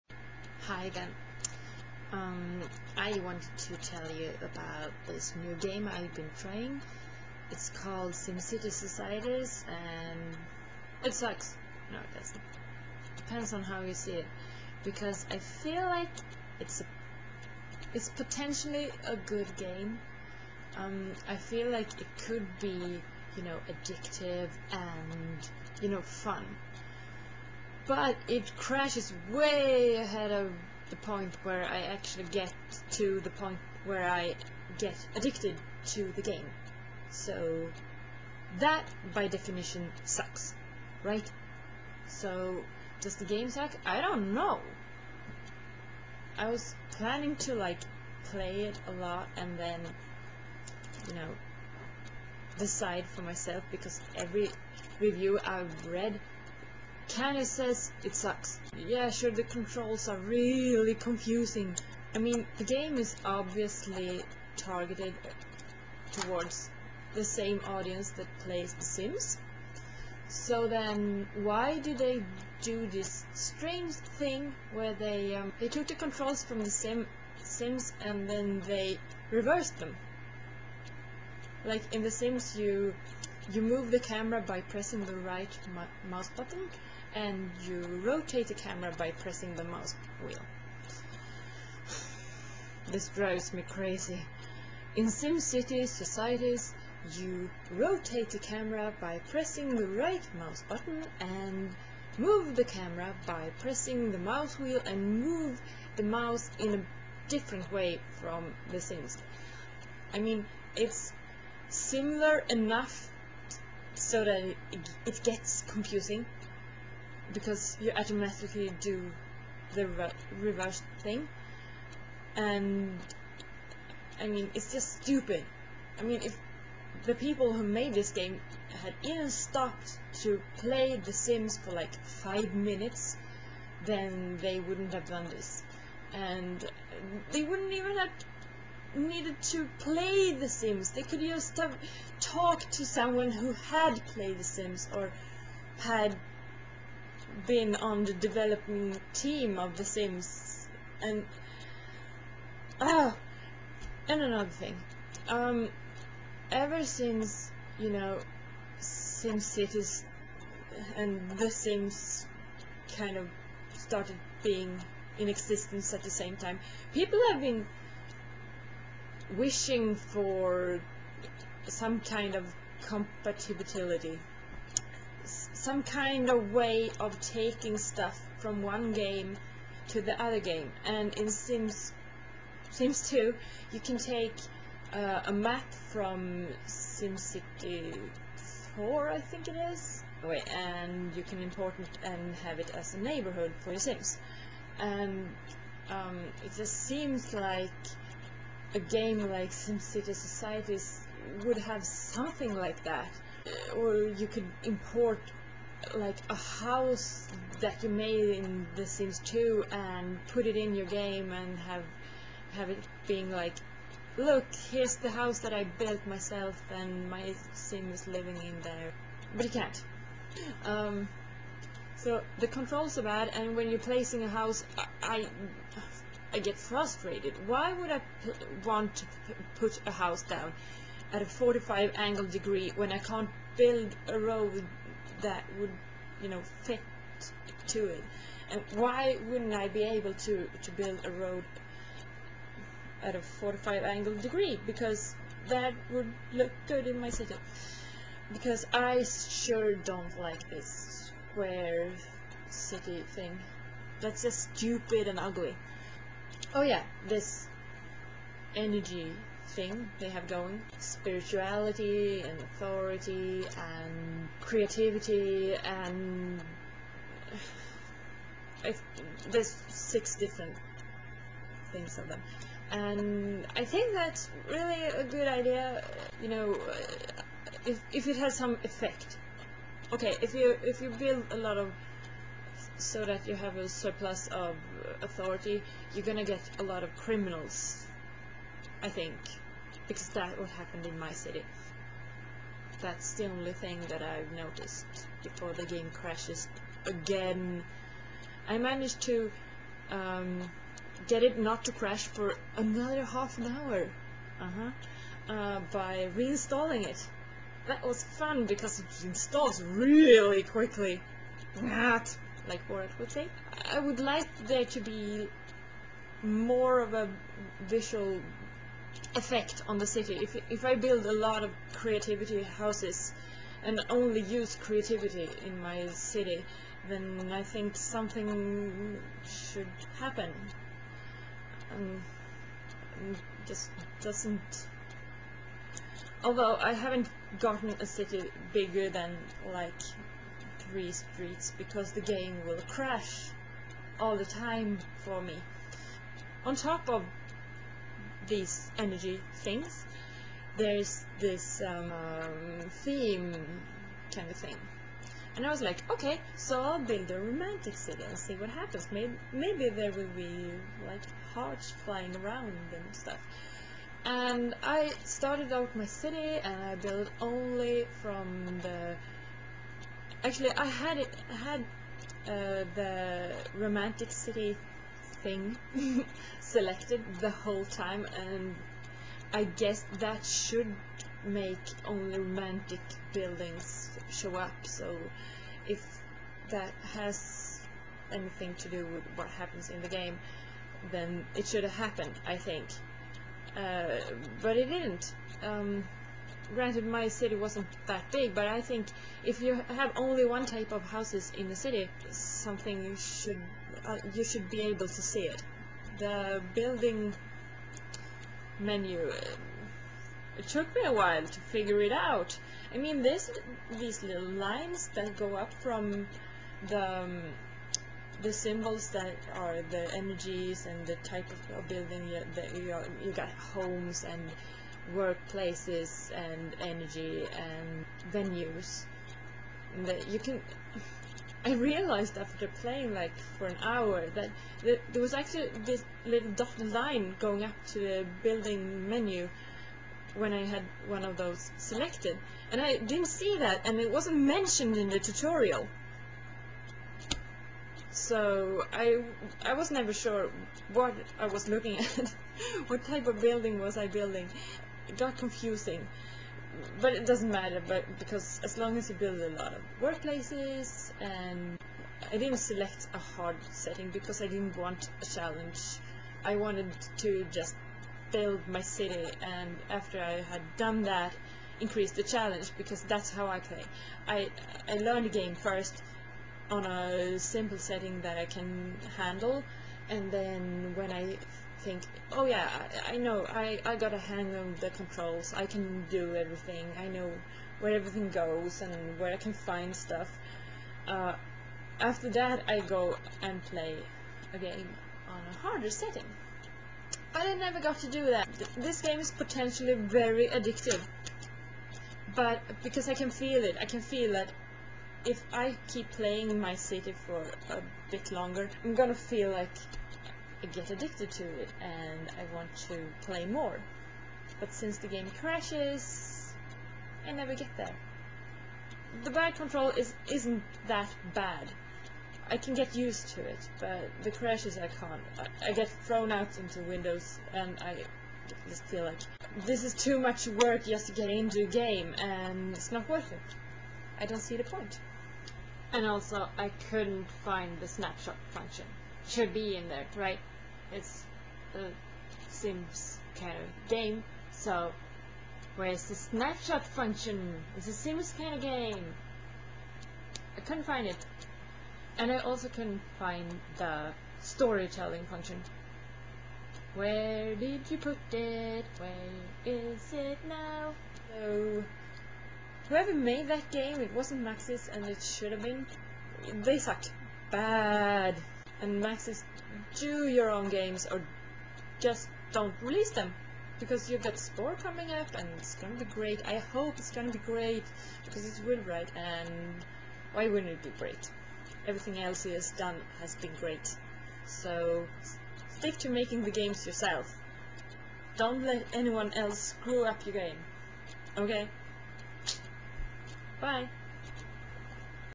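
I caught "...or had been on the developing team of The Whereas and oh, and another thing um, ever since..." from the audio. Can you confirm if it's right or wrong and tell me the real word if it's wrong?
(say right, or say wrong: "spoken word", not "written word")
wrong: "Sims", not "Whereas".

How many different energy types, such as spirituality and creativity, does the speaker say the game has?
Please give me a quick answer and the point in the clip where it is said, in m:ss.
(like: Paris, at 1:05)
6, at 4:29.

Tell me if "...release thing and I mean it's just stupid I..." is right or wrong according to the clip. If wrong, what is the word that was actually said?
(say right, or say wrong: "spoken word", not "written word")
wrong: "reverse", not "release".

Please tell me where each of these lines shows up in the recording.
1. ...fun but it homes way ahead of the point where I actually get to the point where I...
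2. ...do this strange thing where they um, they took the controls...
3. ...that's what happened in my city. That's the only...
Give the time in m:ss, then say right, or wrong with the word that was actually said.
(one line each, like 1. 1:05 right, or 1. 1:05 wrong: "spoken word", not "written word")
1. 0:26 wrong: "crashes", not "homes"
2. 1:12 right
3. 4:50 right.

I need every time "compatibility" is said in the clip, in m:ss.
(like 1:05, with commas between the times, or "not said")
2:52.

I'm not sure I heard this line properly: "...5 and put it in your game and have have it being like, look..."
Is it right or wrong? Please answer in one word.
wrong.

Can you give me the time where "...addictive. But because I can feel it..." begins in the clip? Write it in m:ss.
8:20.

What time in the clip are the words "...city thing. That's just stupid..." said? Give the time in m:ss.
4:12.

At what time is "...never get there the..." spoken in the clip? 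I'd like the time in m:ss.
8:37.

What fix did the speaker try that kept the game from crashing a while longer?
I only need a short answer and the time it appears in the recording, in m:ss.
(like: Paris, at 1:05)
reinstalling it, at 5:06.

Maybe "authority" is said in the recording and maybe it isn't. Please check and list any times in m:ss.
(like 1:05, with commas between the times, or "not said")
4:22, 4:45.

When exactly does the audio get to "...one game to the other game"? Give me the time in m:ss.
2:58.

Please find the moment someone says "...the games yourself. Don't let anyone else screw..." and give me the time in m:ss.
9:46.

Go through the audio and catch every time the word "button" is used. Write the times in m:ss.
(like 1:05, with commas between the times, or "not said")
1:26, 1:40.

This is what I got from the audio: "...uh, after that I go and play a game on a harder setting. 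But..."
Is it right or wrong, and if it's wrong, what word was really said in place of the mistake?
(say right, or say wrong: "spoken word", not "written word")
right.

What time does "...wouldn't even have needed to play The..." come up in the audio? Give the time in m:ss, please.
2:17.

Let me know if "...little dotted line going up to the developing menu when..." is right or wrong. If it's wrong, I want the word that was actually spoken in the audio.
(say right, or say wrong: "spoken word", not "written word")
wrong: "building", not "developing".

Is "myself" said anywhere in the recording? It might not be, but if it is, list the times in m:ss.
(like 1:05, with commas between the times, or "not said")
0:53, 3:36.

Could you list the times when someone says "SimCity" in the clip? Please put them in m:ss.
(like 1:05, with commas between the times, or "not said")
0:08, 1:35, 3:06, 3:19.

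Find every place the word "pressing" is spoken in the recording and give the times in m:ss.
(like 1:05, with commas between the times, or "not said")
1:24, 1:29, 1:39, 1:43.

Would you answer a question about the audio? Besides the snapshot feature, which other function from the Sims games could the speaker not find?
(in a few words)
storytelling function.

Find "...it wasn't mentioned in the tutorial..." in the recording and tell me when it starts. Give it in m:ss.
7:23.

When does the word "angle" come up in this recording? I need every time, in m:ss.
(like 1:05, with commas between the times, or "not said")
3:51, 4:03.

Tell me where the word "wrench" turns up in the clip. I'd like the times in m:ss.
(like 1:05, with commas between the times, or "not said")
not said.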